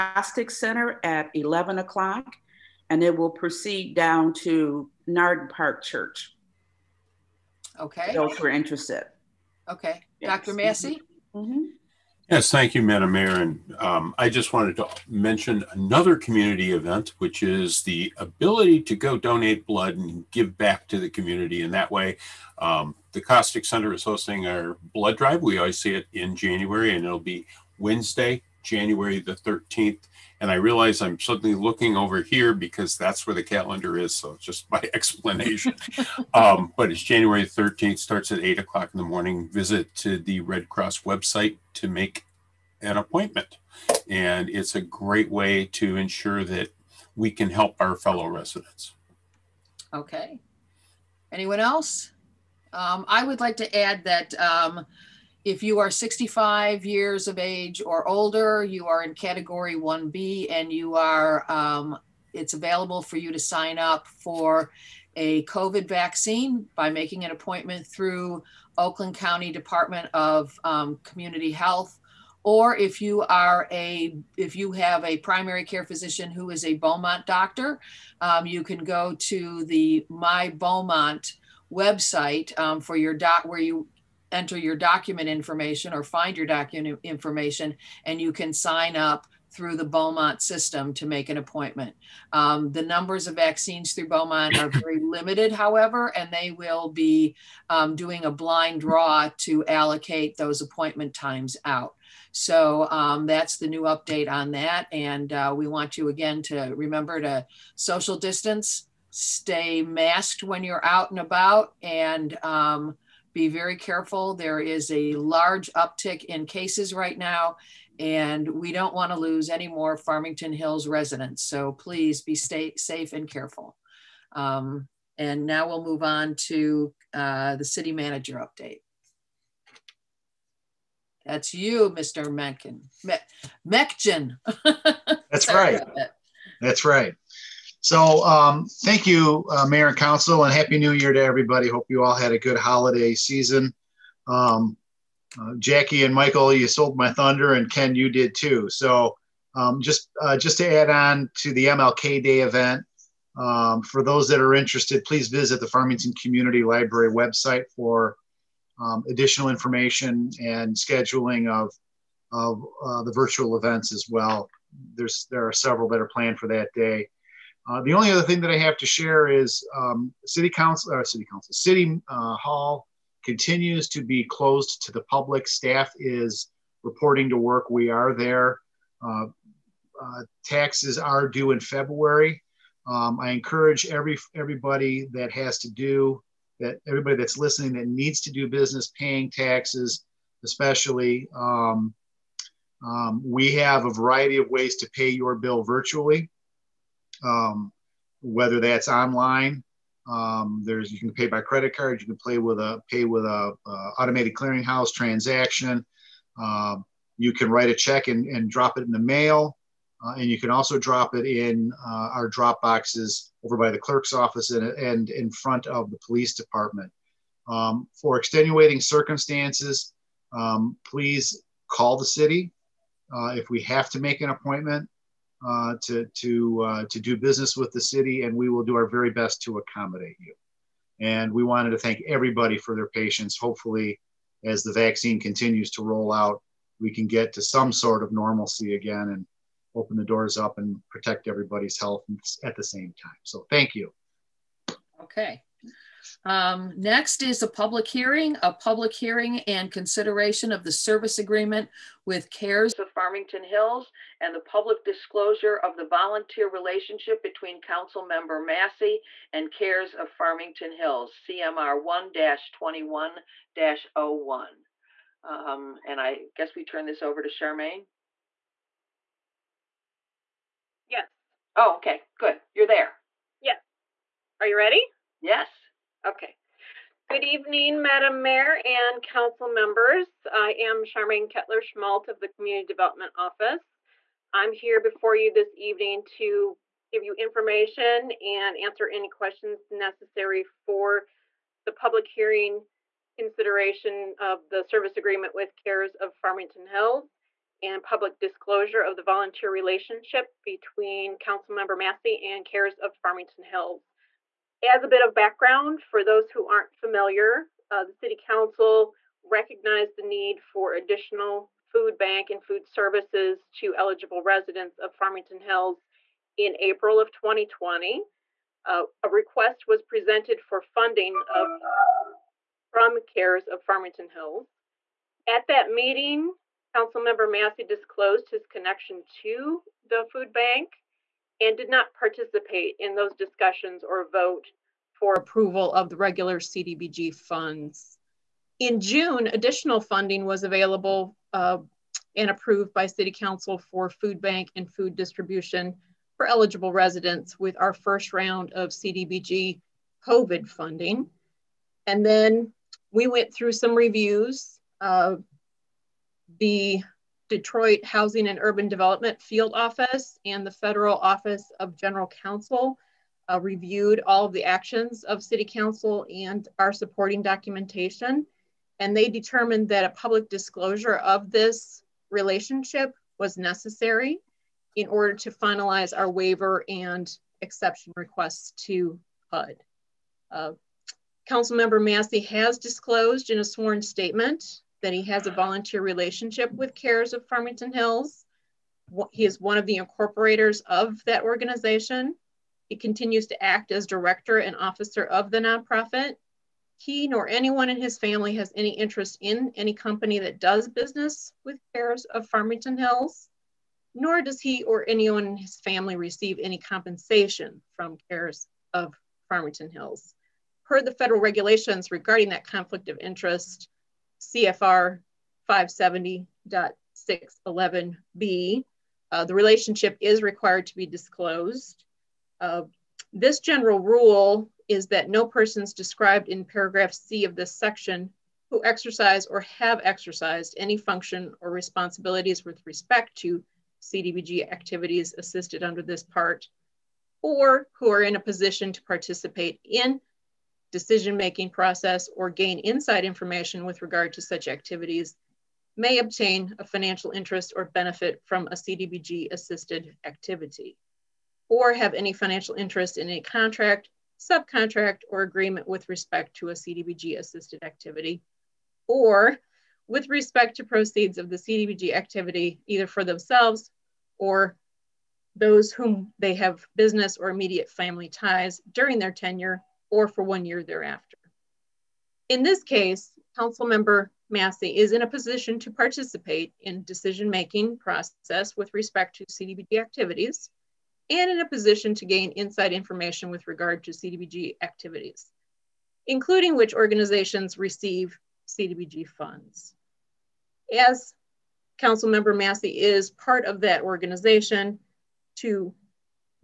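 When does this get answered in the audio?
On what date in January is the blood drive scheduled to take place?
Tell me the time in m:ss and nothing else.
0:27.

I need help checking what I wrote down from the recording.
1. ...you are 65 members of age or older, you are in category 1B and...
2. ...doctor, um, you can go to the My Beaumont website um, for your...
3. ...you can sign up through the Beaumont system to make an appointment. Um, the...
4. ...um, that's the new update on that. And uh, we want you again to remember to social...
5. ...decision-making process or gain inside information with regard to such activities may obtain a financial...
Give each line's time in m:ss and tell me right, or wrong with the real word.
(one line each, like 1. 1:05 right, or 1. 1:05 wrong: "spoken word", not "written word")
1. 0:55 wrong: "years", not "members"
2. 1:17 right
3. 1:28 right
4. 1:42 right
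5. 7:20 right.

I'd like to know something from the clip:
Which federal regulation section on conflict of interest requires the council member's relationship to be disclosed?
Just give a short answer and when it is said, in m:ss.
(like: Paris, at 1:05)
CFR 570.611B, at 6:54.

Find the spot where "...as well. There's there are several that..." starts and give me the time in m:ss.
2:43.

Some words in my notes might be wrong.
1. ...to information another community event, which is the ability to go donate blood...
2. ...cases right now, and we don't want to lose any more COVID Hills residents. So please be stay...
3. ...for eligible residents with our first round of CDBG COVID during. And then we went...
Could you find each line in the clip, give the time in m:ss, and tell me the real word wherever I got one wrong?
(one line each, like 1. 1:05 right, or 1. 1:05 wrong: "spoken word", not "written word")
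1. 0:14 wrong: "mention", not "information"
2. 1:56 wrong: "Farmington", not "COVID"
3. 5:46 wrong: "funding", not "during".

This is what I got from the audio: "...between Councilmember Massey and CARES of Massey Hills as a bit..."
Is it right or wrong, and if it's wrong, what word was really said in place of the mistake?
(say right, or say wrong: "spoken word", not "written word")
wrong: "Farmington", not "Massey".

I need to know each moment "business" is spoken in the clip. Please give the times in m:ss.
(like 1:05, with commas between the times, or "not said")
3:08, 3:47, 6:40, 7:46.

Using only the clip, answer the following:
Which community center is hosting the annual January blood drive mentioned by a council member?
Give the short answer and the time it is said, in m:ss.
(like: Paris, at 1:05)
Costick Center, at 0:23.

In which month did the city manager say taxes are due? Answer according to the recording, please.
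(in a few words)
February.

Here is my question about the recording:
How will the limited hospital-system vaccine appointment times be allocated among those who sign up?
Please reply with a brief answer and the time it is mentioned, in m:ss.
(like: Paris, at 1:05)
blind draw, at 1:38.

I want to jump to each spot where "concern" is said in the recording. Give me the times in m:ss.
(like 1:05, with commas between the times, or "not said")
not said.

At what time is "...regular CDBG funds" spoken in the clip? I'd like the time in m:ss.
5:35.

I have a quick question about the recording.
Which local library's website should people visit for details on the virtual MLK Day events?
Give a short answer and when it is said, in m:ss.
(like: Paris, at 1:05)
Farmington Community Library, at 2:35.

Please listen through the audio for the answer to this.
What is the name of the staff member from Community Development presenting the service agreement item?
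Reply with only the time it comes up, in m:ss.
4:40.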